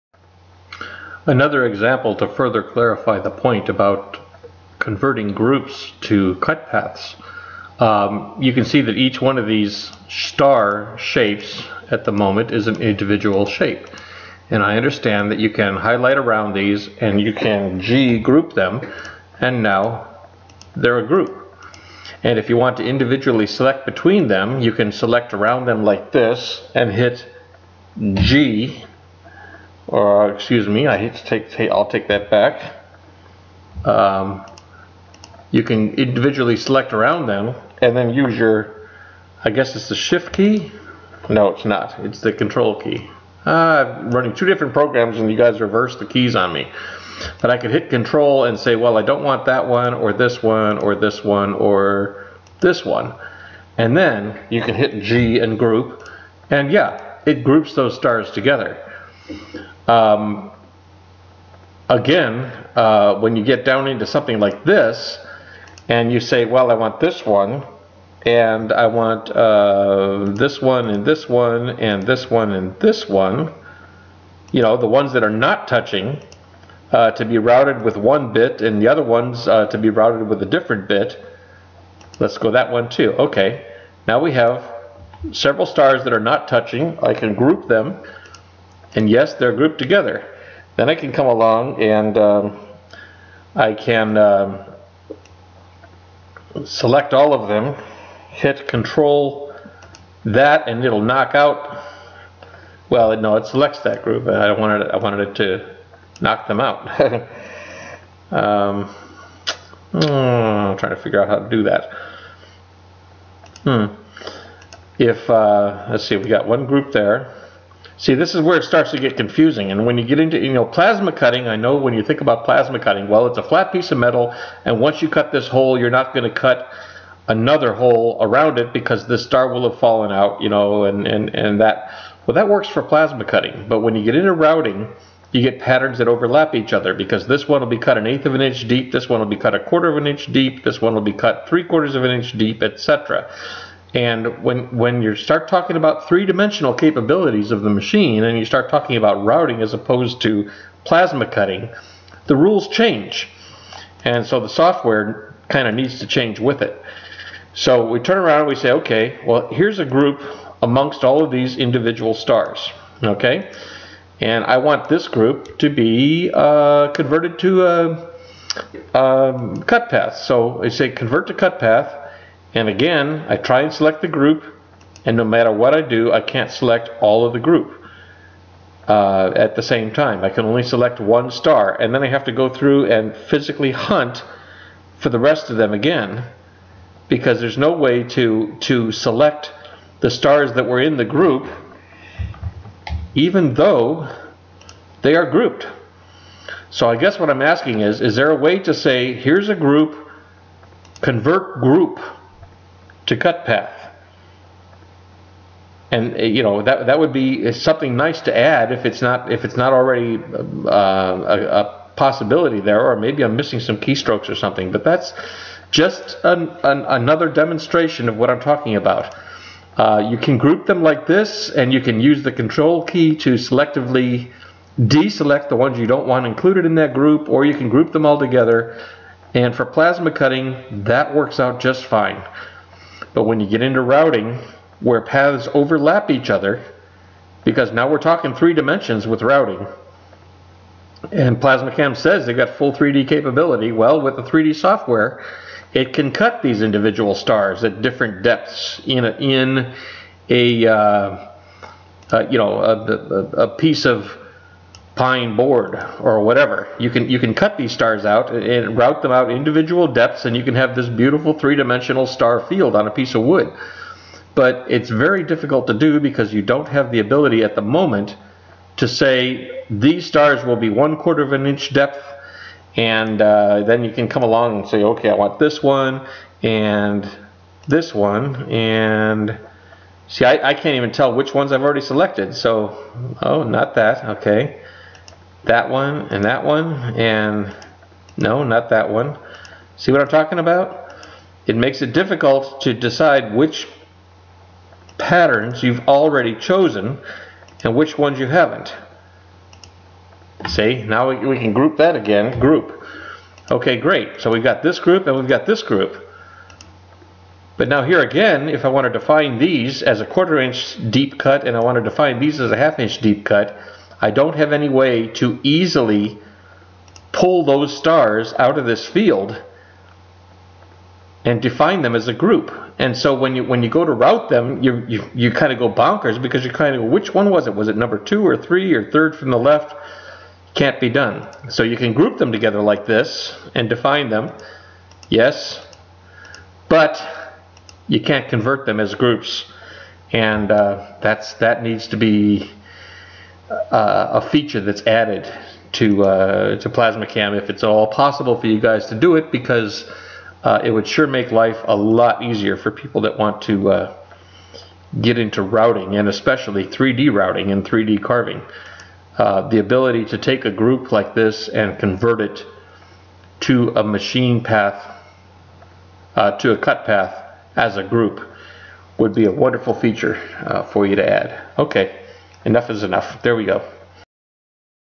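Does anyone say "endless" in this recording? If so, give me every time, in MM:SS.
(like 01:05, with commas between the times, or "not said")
not said.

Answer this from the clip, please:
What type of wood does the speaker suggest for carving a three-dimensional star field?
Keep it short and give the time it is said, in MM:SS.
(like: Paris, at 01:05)
pine, at 04:14.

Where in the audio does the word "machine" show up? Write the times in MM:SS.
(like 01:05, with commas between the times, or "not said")
02:27, 06:03.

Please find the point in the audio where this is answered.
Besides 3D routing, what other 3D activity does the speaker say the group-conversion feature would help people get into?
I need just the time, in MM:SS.
05:57.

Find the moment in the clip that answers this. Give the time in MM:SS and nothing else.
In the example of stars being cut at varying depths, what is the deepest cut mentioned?
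02:21.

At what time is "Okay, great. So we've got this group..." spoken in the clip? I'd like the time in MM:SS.
05:03.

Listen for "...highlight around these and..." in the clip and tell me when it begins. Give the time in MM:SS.
00:15.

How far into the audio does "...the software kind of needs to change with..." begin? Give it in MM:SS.
02:34.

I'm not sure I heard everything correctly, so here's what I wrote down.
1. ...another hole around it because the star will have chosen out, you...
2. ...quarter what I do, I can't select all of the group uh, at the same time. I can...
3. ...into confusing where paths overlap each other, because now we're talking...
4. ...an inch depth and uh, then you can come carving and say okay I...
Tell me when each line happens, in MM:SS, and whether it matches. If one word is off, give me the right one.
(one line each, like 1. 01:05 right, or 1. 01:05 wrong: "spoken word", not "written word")
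1. 02:07 wrong: "fallen", not "chosen"
2. 02:55 wrong: "matter", not "quarter"
3. 03:53 wrong: "routing", not "confusing"
4. 04:31 wrong: "along", not "carving".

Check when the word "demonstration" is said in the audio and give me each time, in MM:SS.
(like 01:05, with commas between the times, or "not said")
03:37.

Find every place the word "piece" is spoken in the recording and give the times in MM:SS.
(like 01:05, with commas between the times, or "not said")
02:03, 04:13, 04:22.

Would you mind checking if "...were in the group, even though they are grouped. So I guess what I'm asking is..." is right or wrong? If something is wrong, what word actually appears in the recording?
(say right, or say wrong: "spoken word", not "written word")
right.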